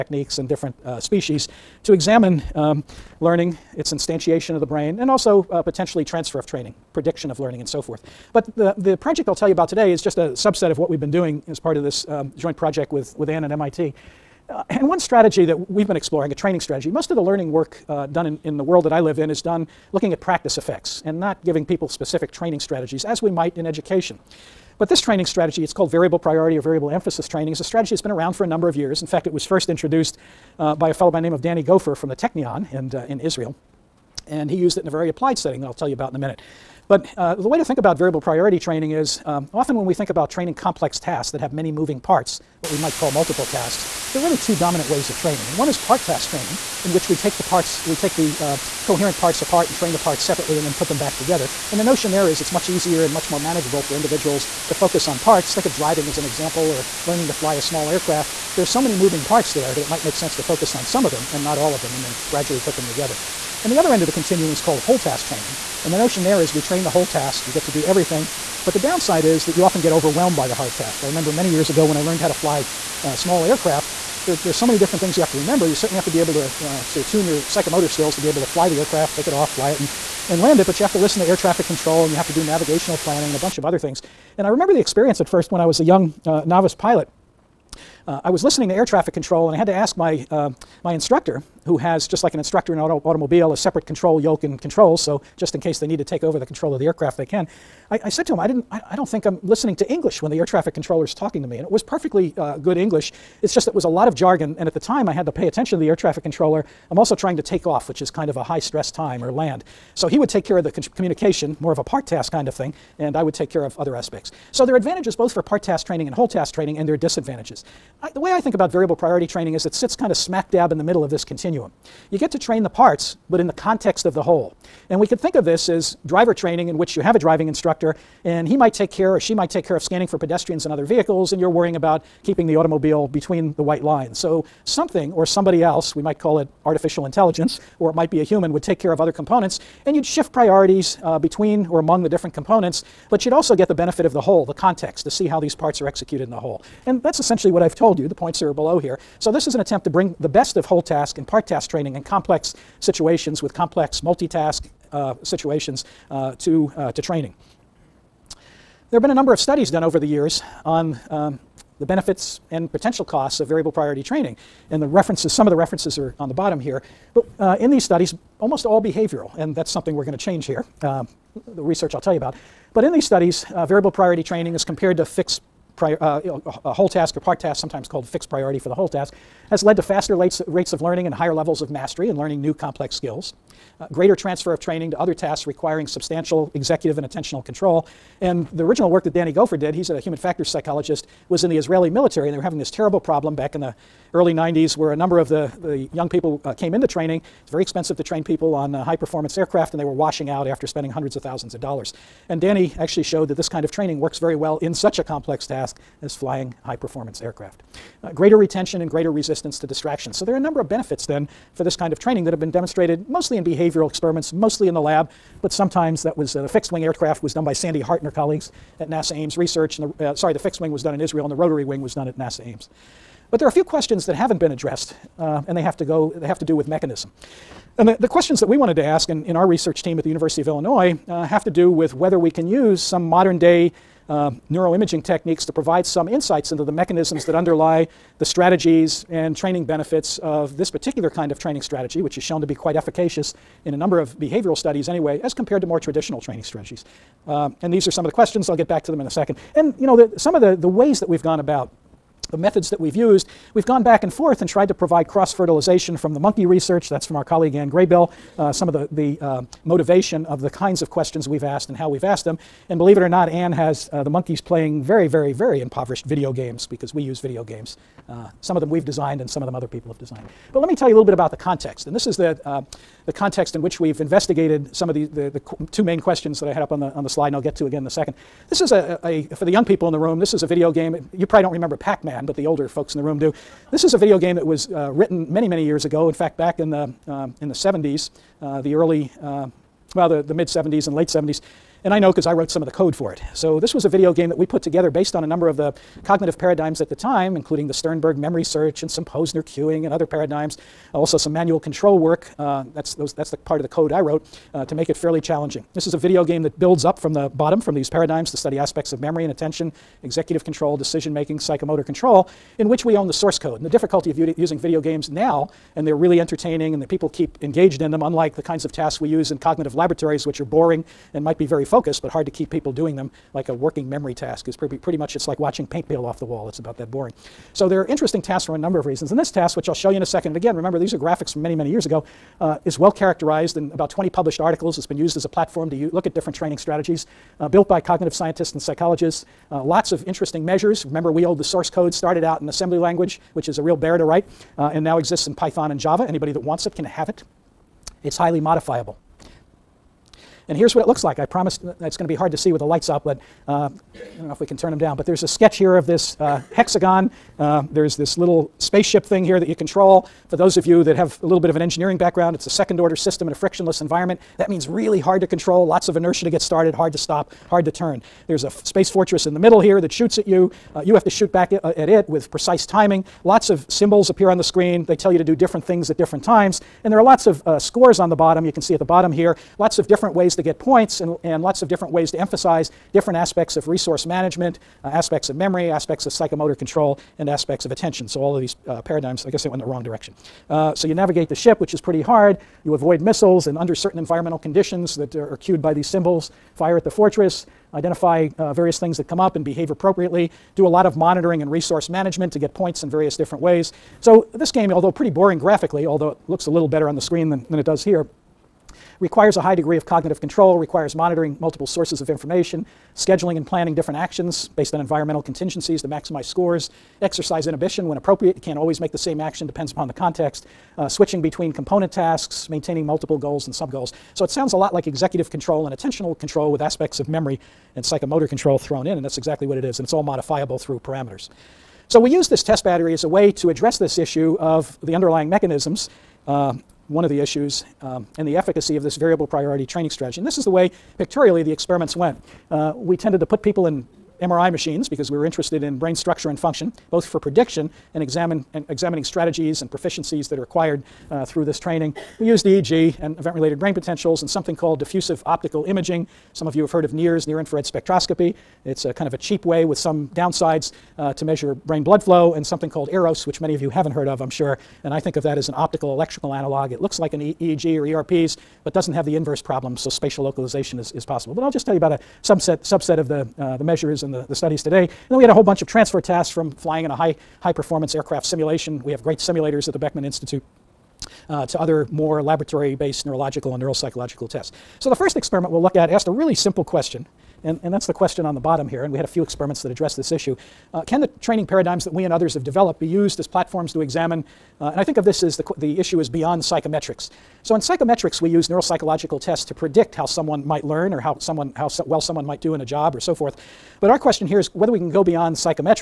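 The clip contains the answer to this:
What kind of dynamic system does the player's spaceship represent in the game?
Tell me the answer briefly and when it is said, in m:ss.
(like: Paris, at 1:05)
second order system, at 6:02.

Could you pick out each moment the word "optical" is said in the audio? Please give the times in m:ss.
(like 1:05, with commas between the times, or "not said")
7:35, 7:45.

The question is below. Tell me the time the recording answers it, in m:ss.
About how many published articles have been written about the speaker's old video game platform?
5:33.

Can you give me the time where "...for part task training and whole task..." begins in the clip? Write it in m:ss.
1:55.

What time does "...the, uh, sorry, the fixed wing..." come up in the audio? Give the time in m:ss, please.
3:39.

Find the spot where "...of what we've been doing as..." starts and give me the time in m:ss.
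0:10.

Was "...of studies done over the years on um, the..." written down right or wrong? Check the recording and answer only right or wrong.
right.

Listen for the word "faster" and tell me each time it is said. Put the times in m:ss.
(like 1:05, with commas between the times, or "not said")
2:59.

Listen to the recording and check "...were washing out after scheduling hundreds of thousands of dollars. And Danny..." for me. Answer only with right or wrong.
wrong.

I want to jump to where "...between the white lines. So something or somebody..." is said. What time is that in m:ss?
2:13.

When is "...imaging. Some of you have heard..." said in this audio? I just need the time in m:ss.
7:35.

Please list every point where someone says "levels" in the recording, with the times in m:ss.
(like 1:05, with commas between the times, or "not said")
3:01.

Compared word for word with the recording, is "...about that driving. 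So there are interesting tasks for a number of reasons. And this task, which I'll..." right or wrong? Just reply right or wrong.
wrong.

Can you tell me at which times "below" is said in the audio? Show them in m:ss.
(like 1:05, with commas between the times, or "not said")
2:28.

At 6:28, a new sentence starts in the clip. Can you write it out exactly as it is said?
So all of these uh, paradigms, I guess they went in the wrong direction.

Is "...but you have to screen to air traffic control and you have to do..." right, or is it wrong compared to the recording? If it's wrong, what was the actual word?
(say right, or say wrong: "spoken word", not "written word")
wrong: "listen", not "screen".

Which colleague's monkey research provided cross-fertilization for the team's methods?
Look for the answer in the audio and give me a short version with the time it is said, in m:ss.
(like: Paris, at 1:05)
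Ann Graybiel, at 4:17.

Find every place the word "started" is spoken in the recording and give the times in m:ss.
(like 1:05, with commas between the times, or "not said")
5:41, 6:06.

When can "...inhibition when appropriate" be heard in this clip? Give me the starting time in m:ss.
6:57.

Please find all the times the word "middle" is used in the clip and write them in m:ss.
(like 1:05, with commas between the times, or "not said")
2:00, 6:09.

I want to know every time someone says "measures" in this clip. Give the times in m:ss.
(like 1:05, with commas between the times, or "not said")
5:40, 7:41, 7:53.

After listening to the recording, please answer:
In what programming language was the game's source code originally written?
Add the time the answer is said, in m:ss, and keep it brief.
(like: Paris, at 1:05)
assembly language, at 5:42.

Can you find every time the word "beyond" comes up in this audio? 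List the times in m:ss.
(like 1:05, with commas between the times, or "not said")
8:16, 8:25.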